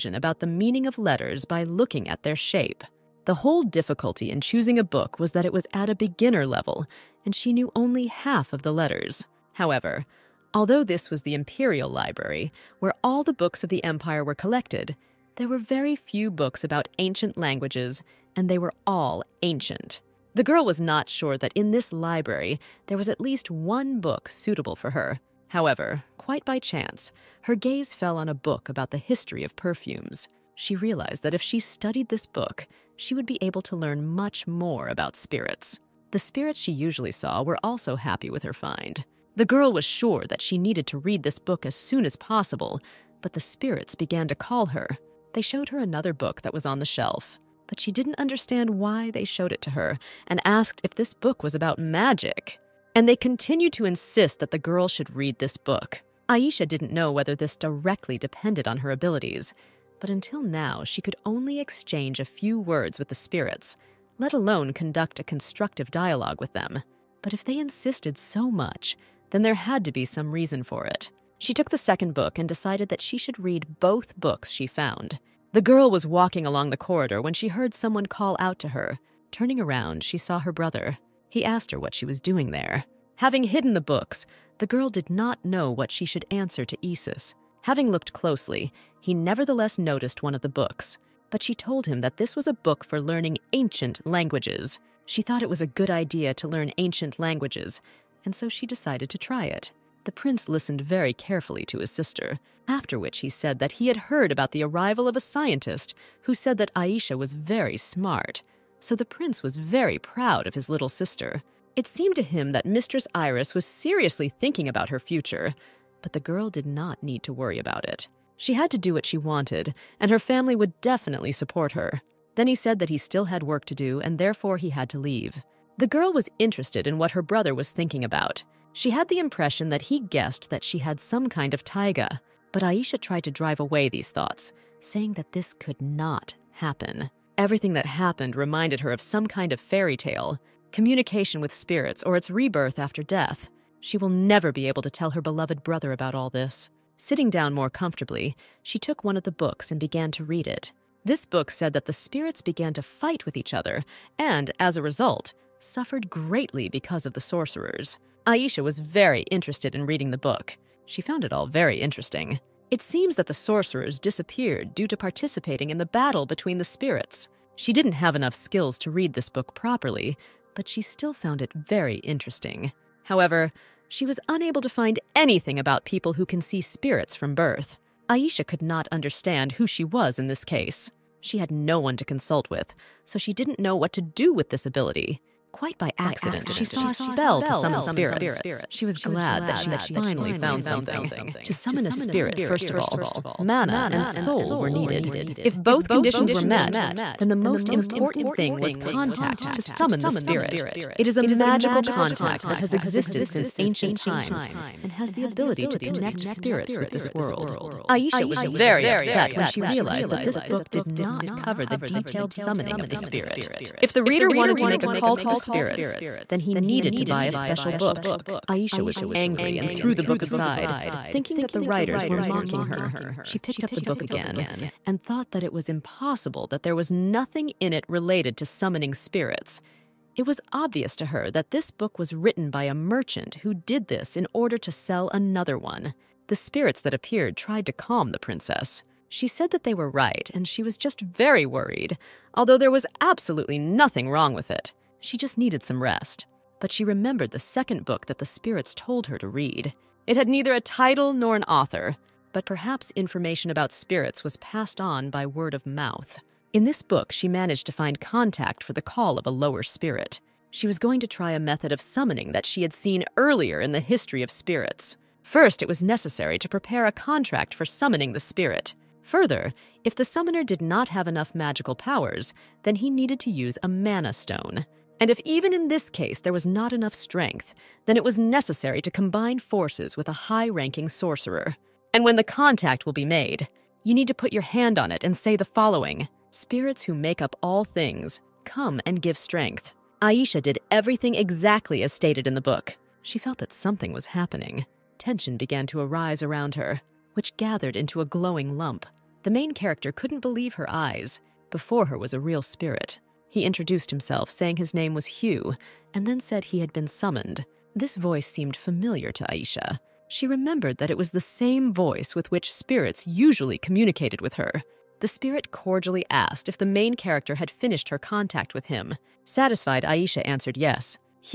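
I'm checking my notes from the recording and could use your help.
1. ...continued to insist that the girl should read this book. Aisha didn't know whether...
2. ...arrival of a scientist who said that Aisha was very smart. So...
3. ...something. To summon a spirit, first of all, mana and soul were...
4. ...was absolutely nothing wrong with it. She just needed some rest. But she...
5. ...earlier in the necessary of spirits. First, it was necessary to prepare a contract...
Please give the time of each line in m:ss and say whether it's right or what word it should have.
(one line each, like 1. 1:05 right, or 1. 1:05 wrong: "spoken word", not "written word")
1. 0:53 right
2. 1:44 right
3. 3:10 right
4. 4:02 right
5. 4:23 wrong: "history", not "necessary".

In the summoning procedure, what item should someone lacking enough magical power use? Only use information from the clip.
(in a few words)
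Mana stone.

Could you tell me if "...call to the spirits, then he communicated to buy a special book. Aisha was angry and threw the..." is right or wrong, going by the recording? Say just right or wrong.
wrong.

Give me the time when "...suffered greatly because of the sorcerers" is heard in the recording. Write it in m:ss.
2:35.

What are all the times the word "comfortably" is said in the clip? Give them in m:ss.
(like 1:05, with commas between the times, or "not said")
2:27.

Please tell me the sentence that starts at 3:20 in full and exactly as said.
It is a magical contact that has existed since ancient times and has the ability to connect spirits with this world.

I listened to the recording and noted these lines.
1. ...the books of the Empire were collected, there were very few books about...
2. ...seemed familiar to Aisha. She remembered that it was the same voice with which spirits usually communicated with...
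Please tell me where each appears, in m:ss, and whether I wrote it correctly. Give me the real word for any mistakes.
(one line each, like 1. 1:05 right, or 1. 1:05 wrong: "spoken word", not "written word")
1. 0:13 right
2. 5:08 right.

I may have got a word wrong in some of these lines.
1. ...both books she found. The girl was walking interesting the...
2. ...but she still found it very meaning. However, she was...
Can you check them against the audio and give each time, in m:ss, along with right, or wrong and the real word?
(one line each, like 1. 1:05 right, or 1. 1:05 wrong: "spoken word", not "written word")
1. 1:13 wrong: "along", not "interesting"
2. 2:50 wrong: "interesting", not "meaning".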